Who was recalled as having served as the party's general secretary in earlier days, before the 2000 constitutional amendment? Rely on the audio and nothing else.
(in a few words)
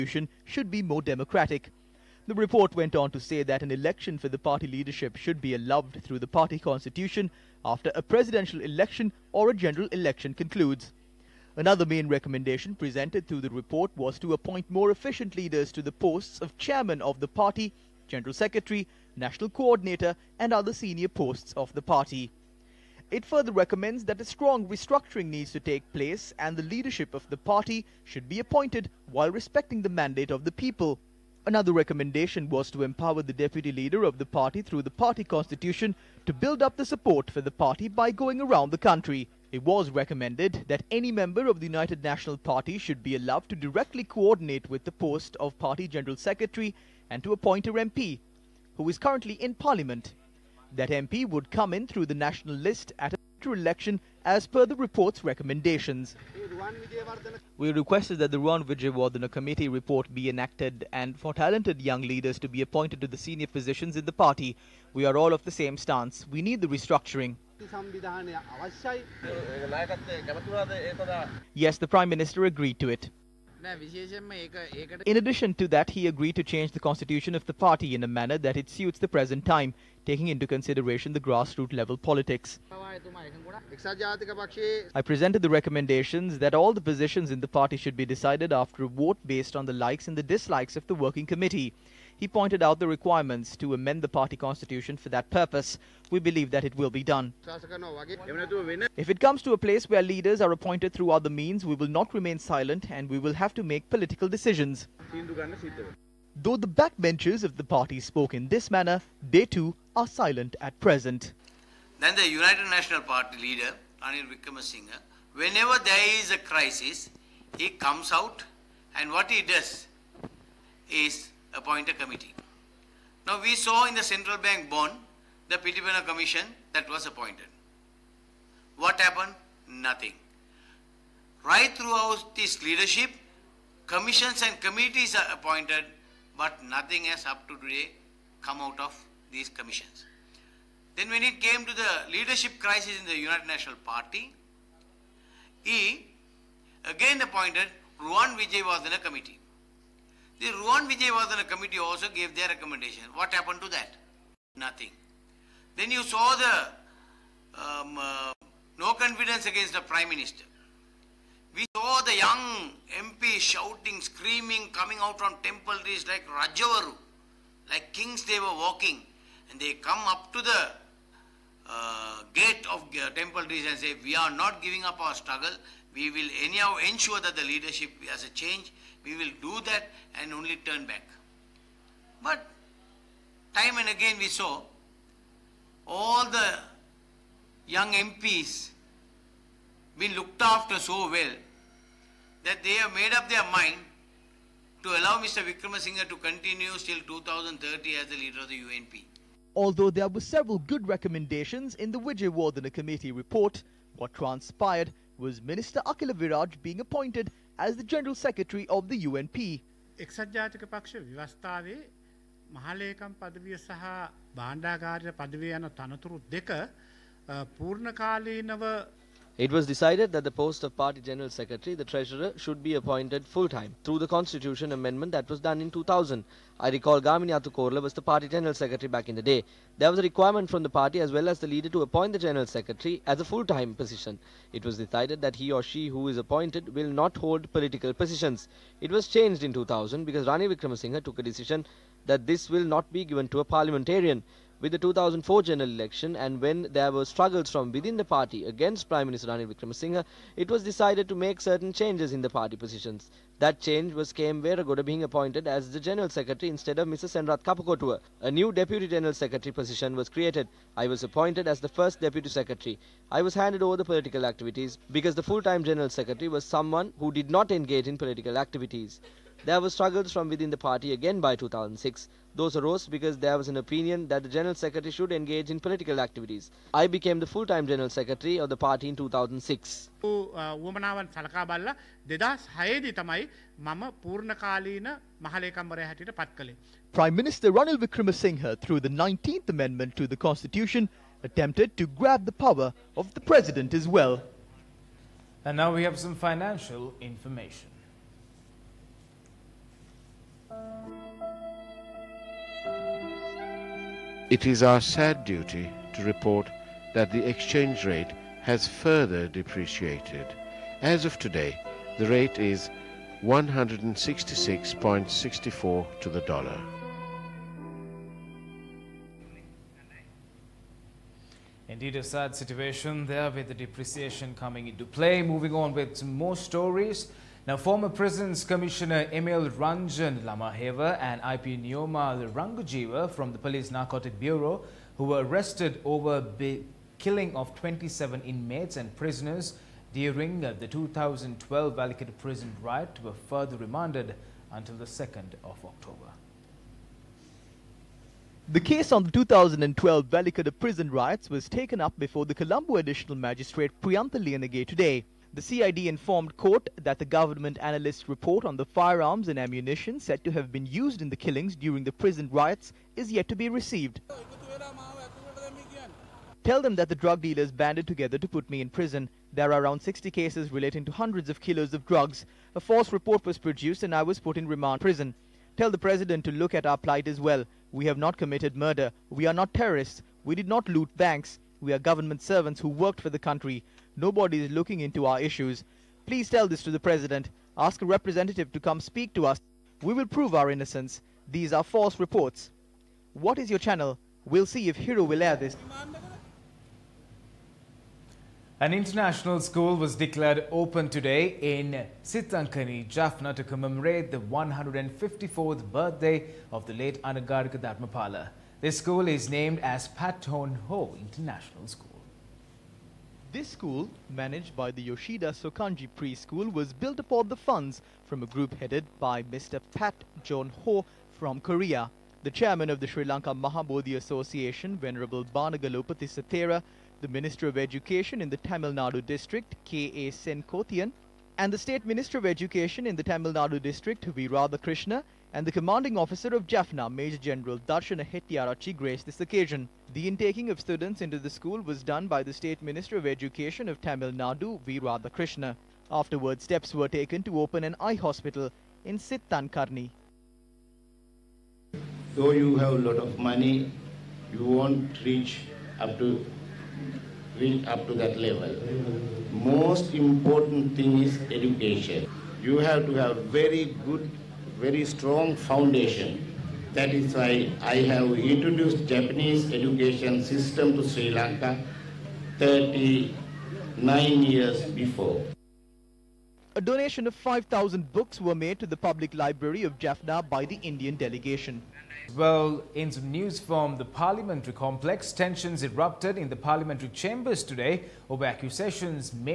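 Gamini Athukorala.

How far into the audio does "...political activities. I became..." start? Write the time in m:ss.
4:35.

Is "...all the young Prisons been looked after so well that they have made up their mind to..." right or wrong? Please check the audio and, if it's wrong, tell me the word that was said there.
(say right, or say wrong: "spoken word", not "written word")
wrong: "MPs", not "Prisons".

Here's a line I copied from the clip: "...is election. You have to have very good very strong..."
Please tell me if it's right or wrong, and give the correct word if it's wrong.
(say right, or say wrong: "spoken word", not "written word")
wrong: "education", not "election".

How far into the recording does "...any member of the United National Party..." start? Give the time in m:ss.
0:40.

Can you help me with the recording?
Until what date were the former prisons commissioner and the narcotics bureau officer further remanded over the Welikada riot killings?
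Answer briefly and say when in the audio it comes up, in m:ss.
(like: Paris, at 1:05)
2nd of October, at 5:44.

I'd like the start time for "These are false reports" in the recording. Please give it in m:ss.
6:31.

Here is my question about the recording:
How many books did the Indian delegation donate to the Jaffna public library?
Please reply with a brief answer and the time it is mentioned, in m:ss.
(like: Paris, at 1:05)
5,000, at 7:57.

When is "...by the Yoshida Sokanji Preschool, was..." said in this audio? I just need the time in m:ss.
6:54.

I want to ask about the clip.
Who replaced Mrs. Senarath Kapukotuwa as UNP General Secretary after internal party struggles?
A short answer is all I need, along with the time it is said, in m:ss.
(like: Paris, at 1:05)
K.M. Veragoda, at 4:14.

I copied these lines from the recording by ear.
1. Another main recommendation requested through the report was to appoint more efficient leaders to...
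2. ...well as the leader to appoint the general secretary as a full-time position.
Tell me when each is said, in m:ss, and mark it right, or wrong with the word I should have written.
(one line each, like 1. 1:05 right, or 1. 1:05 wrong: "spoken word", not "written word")
1. 0:11 wrong: "presented", not "requested"
2. 3:51 right.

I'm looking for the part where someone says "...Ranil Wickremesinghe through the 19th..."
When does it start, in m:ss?
4:47.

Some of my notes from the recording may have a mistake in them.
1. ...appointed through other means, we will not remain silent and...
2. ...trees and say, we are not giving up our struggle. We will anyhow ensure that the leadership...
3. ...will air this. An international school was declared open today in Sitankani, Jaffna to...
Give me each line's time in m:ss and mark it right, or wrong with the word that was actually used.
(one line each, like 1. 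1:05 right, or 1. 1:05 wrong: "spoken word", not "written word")
1. 1:40 right
2. 2:53 right
3. 6:35 right.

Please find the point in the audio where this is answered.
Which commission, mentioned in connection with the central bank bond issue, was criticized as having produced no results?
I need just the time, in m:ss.
2:05.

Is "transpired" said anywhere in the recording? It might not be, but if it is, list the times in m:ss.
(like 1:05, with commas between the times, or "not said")
3:24.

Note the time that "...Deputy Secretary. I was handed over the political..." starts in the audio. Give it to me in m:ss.
4:21.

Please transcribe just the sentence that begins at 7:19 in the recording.
The intaking of students into the school was done by the State Minister of Education of Tamil Nadu, V.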